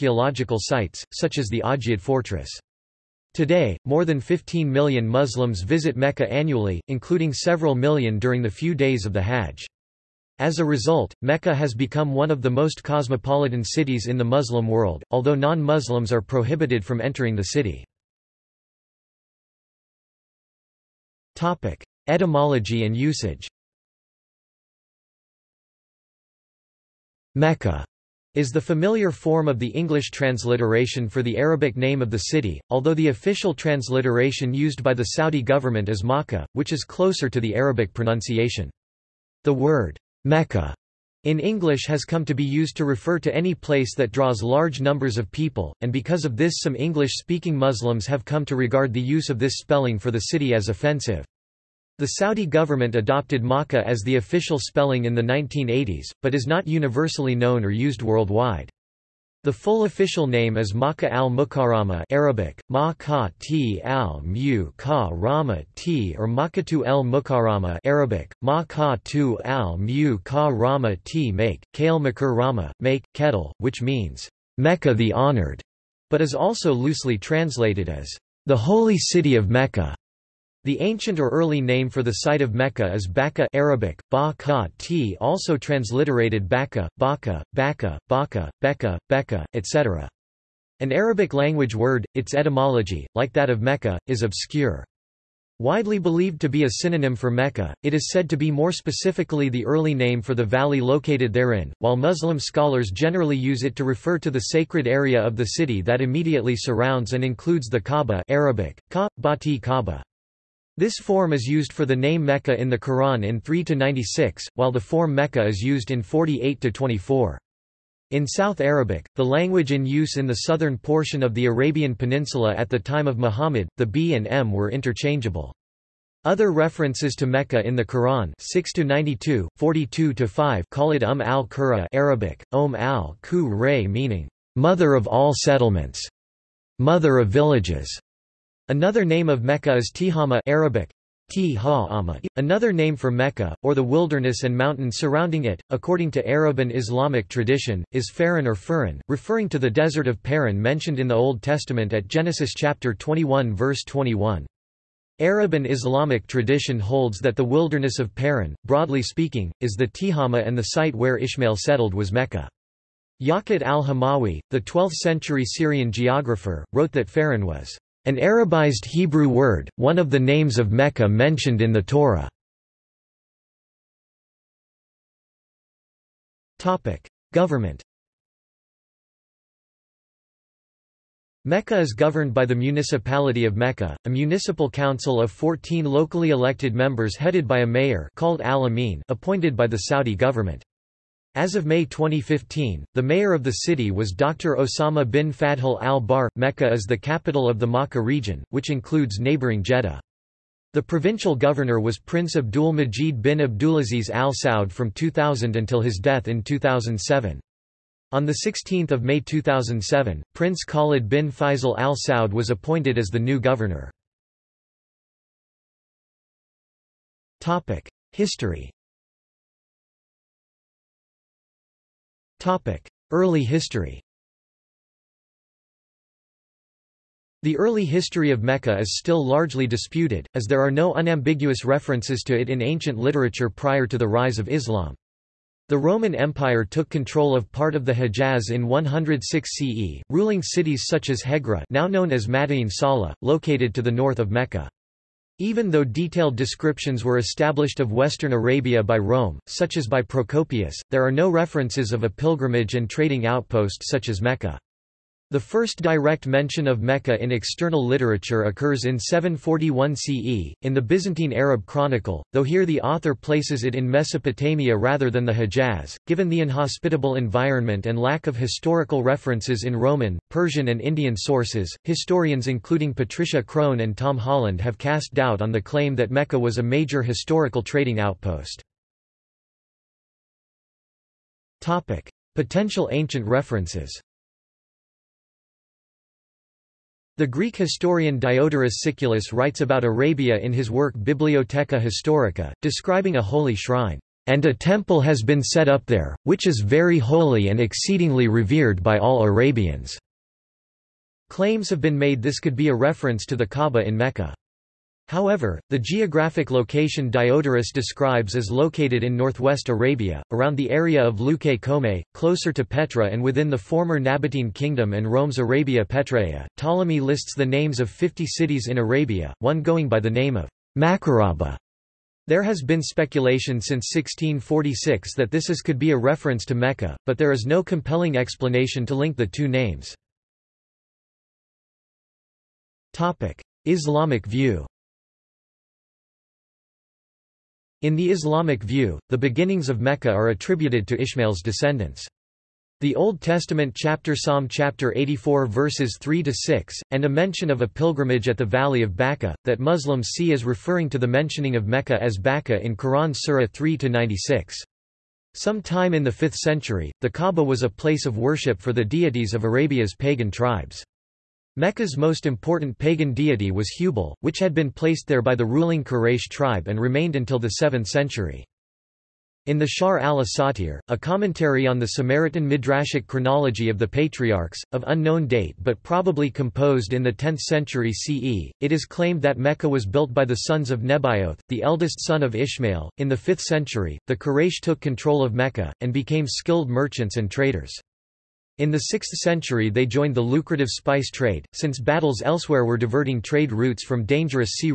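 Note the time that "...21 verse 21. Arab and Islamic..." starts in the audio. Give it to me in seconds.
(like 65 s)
152 s.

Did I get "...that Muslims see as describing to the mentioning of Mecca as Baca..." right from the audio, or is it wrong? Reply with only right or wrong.
wrong.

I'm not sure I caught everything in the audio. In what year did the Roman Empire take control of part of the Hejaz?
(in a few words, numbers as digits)
106 CE.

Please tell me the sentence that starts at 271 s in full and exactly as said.
Historians including Patricia Crone and Tom Holland have cast doubt on the claim that Mecca was a major historical trading outpost.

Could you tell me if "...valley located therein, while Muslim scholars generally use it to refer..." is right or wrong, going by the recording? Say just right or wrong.
right.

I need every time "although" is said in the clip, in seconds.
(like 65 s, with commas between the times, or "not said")
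15 s, 32 s.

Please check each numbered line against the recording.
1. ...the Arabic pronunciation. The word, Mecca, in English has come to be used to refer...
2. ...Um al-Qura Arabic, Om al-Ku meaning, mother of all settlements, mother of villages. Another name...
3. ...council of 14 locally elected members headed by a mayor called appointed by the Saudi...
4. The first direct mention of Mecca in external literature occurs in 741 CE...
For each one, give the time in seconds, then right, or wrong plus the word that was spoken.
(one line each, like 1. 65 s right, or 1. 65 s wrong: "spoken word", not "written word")
1. 37 s right
2. 131 s right
3. 184 s right
4. 255 s right.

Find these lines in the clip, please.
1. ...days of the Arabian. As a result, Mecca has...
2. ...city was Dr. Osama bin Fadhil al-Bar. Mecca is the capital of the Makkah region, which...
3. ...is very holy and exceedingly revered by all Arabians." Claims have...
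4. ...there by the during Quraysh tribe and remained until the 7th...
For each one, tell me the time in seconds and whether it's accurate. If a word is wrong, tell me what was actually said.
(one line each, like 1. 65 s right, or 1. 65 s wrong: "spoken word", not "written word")
1. 8 s wrong: "Hajj", not "Arabian"
2. 193 s right
3. 296 s right
4. 365 s wrong: "ruling", not "during".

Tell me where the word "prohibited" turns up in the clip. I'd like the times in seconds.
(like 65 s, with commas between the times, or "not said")
16 s.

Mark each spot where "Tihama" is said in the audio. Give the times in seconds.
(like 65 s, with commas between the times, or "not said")
139 s, 159 s.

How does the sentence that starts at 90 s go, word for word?
An Arabic language word, its etymology, like that of Mecca, is obscure.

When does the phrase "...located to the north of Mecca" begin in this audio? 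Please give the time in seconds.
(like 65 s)
243 s.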